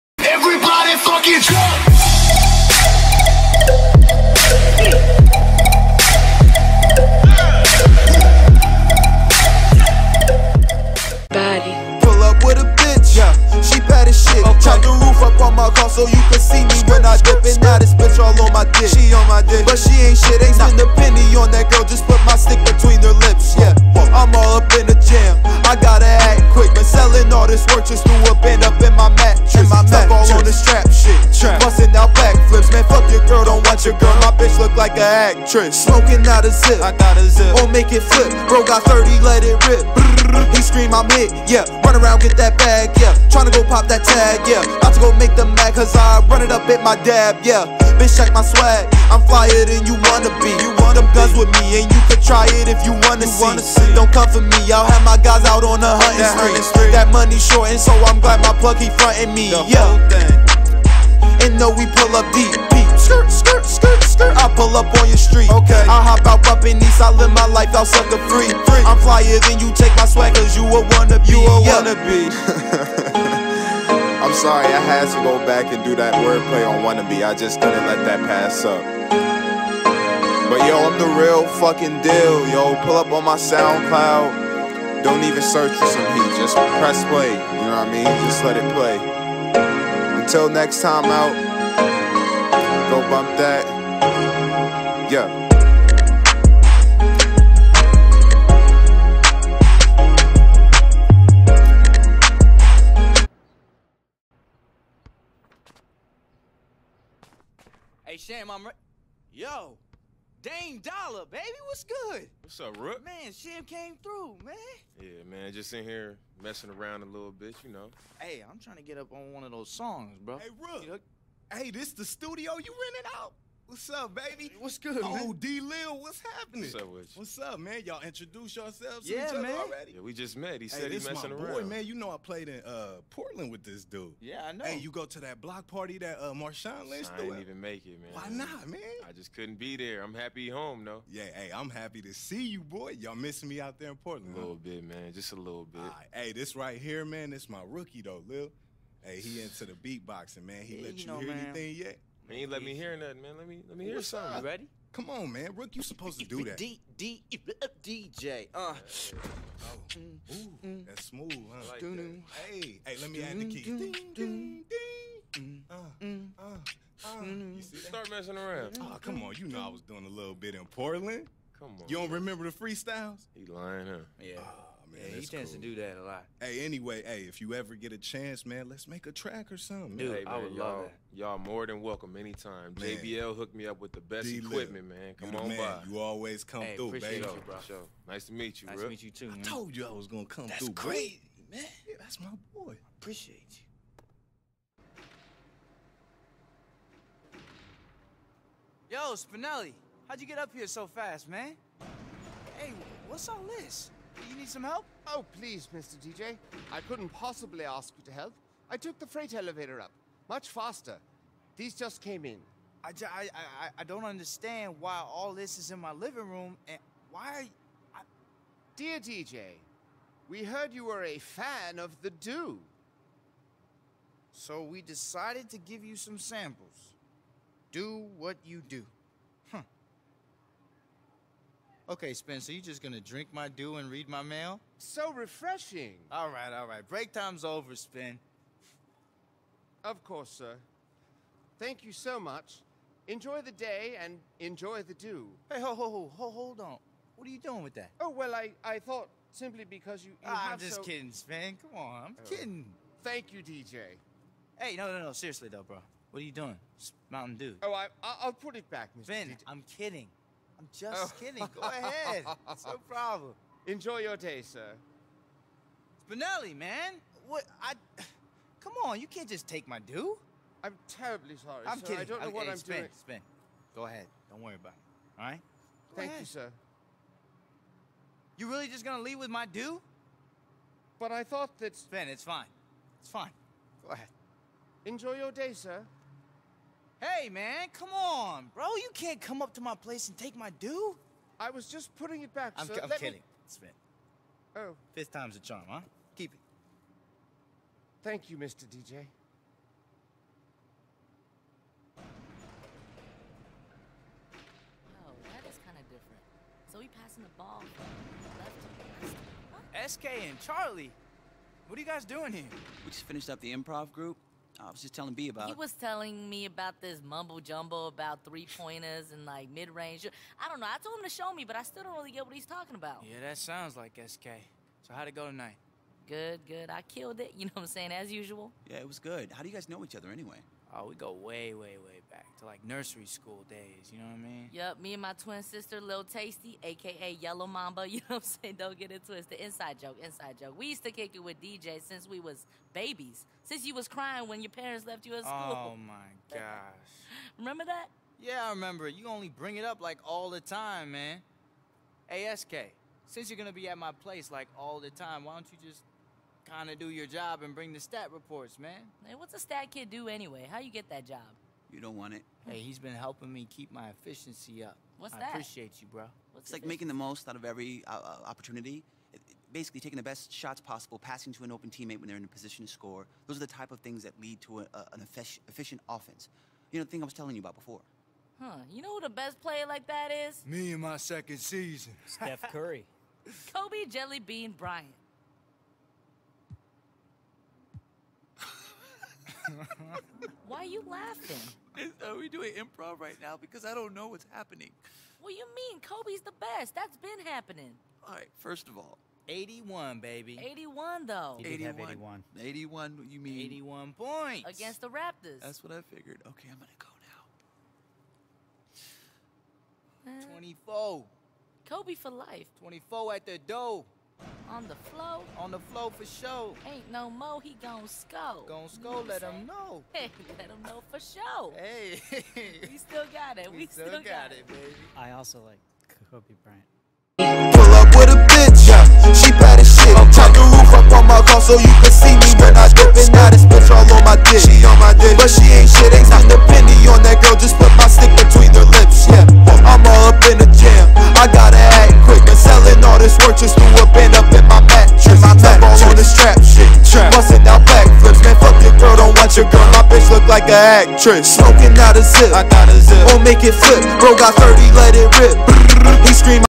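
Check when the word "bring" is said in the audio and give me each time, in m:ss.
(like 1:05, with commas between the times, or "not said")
5:49, 5:57.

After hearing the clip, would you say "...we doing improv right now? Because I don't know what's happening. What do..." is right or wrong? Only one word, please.
right.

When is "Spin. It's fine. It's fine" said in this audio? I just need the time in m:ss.
4:41.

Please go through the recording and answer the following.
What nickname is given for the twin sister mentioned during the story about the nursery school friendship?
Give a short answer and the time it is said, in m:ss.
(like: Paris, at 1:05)
Lil Tasty, at 5:35.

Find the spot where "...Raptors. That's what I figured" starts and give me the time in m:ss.
6:44.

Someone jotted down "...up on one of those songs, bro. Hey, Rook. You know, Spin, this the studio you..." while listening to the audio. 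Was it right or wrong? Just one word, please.
wrong.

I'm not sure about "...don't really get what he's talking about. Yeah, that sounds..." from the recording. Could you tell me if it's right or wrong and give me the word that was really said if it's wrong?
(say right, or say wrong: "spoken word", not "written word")
right.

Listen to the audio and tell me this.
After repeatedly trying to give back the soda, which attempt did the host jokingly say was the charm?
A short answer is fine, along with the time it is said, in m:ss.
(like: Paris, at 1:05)
Fifth, at 4:54.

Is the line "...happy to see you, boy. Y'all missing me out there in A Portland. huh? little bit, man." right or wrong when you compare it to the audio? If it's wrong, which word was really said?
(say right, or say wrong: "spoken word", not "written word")
right.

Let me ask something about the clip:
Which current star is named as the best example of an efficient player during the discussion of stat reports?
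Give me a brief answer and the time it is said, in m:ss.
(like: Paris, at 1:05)
Steph Curry, at 6:22.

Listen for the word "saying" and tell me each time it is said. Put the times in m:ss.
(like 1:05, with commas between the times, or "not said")
5:27, 5:38.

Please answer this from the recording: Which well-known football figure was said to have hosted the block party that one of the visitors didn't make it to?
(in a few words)
Marshawn Lynch.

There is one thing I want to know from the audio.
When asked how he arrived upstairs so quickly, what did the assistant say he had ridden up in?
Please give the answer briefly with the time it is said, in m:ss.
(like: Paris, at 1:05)
The freight elevator, at 3:29.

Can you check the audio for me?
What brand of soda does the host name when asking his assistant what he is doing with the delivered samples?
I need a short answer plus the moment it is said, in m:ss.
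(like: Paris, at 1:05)
Mountain Dew, at 4:17.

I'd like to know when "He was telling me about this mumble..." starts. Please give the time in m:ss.
5:15.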